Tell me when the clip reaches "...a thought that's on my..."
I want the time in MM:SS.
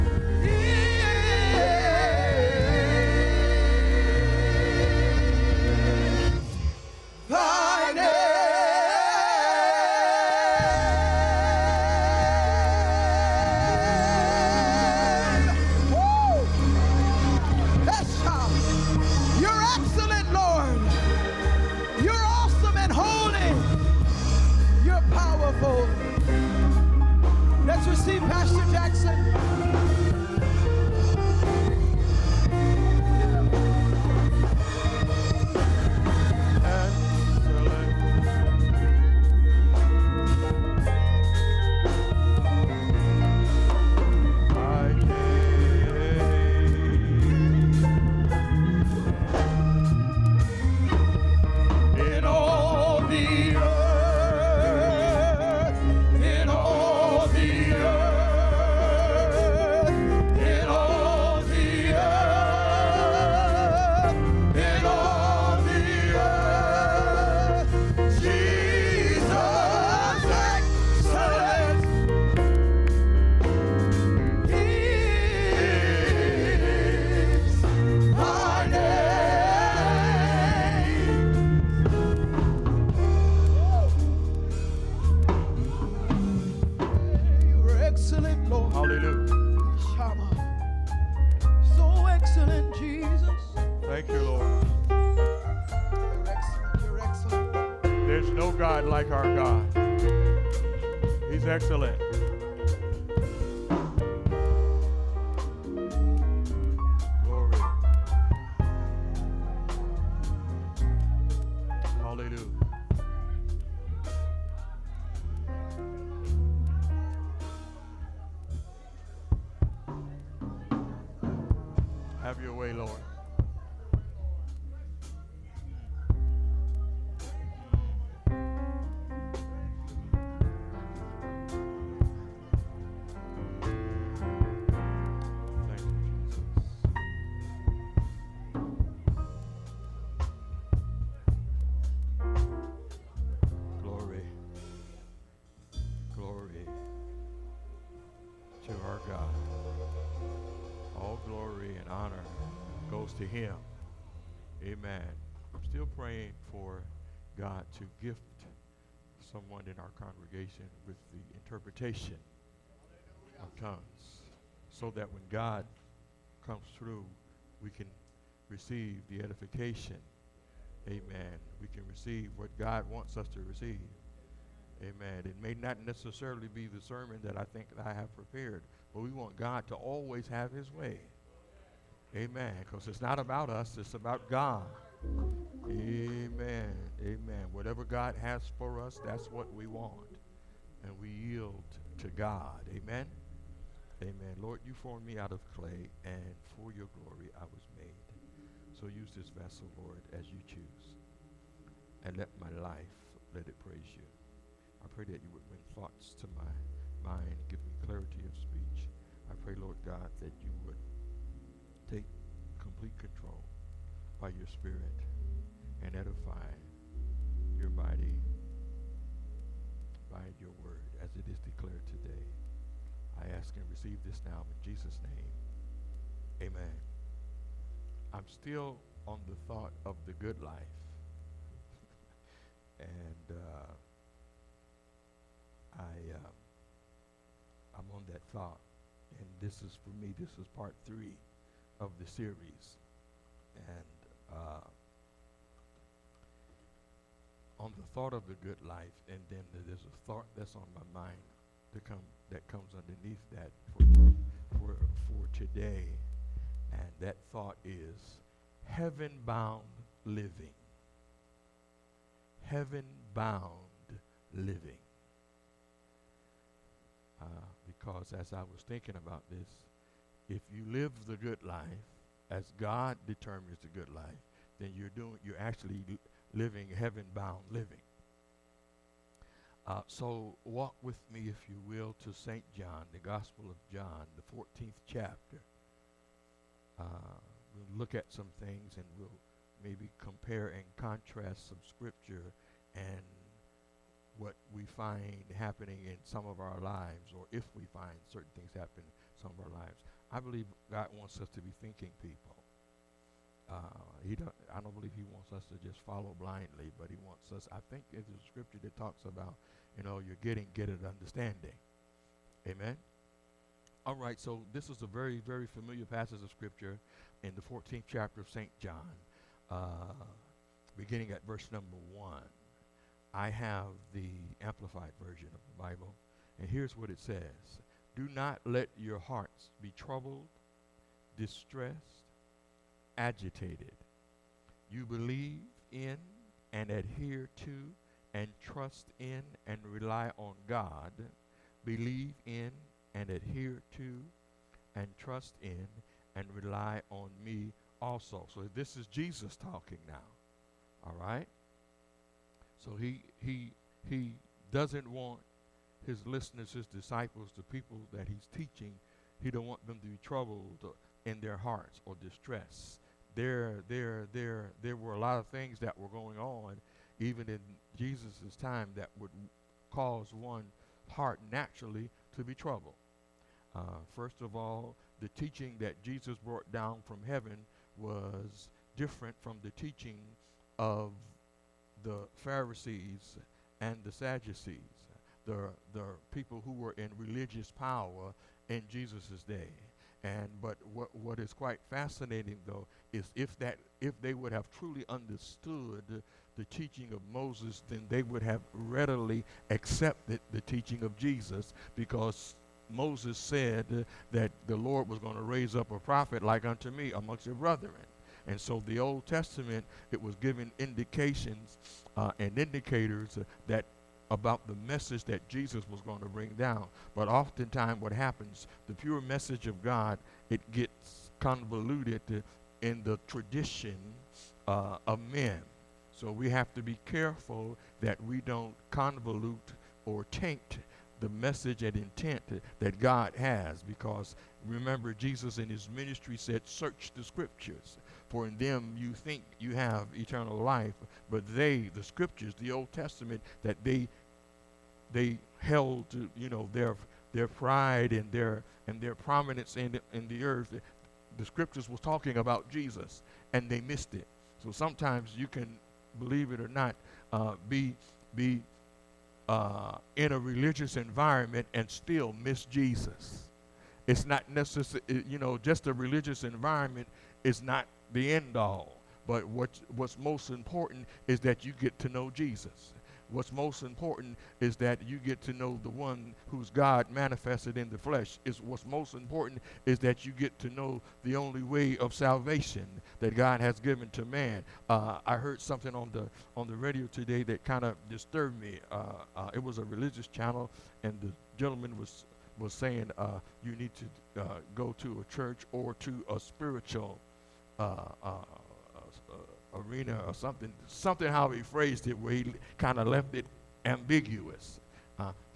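04:09.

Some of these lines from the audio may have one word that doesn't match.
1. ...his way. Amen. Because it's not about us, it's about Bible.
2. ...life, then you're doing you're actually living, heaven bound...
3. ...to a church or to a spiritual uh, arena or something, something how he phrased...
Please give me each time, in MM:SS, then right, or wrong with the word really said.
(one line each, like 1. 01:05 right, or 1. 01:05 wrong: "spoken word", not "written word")
1. 03:00 wrong: "God", not "Bible"
2. 04:33 right
3. 08:14 right.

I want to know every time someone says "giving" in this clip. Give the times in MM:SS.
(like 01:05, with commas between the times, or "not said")
06:50.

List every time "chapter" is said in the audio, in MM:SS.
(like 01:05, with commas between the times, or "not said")
04:44, 05:17.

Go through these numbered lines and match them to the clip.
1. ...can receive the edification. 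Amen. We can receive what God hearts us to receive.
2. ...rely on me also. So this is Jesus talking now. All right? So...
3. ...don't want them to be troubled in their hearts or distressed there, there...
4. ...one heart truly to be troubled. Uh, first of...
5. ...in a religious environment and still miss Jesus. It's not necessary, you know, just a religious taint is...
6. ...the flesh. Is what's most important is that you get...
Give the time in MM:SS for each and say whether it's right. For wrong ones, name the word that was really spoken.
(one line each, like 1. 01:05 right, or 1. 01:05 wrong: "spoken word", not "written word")
1. 02:47 wrong: "wants", not "hearts"
2. 05:46 right
3. 05:59 right
4. 06:10 wrong: "naturally", not "truly"
5. 07:39 wrong: "environment", not "taint"
6. 07:57 right.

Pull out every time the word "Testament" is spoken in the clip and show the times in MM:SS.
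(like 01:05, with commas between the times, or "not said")
06:49, 07:22.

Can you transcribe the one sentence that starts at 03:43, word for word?
I ask and receive this now in Jesus' name.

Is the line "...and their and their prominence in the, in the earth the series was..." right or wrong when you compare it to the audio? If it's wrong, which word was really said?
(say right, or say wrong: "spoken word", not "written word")
wrong: "scriptures", not "series".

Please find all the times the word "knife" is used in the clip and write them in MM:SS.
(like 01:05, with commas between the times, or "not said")
not said.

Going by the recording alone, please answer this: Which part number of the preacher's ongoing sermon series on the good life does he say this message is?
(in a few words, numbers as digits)
Part three.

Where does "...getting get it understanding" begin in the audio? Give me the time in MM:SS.
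05:10.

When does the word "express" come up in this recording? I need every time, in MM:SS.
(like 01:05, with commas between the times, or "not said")
not said.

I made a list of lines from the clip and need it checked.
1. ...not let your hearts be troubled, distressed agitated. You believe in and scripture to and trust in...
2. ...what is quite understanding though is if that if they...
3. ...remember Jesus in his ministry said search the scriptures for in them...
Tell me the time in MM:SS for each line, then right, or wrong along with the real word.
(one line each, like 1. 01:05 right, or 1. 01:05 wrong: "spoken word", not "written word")
1. 05:28 wrong: "adhere", not "scripture"
2. 06:30 wrong: "fascinating", not "understanding"
3. 07:14 right.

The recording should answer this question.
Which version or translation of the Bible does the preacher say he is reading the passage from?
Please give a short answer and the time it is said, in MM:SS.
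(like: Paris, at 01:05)
Amplified version, at 05:24.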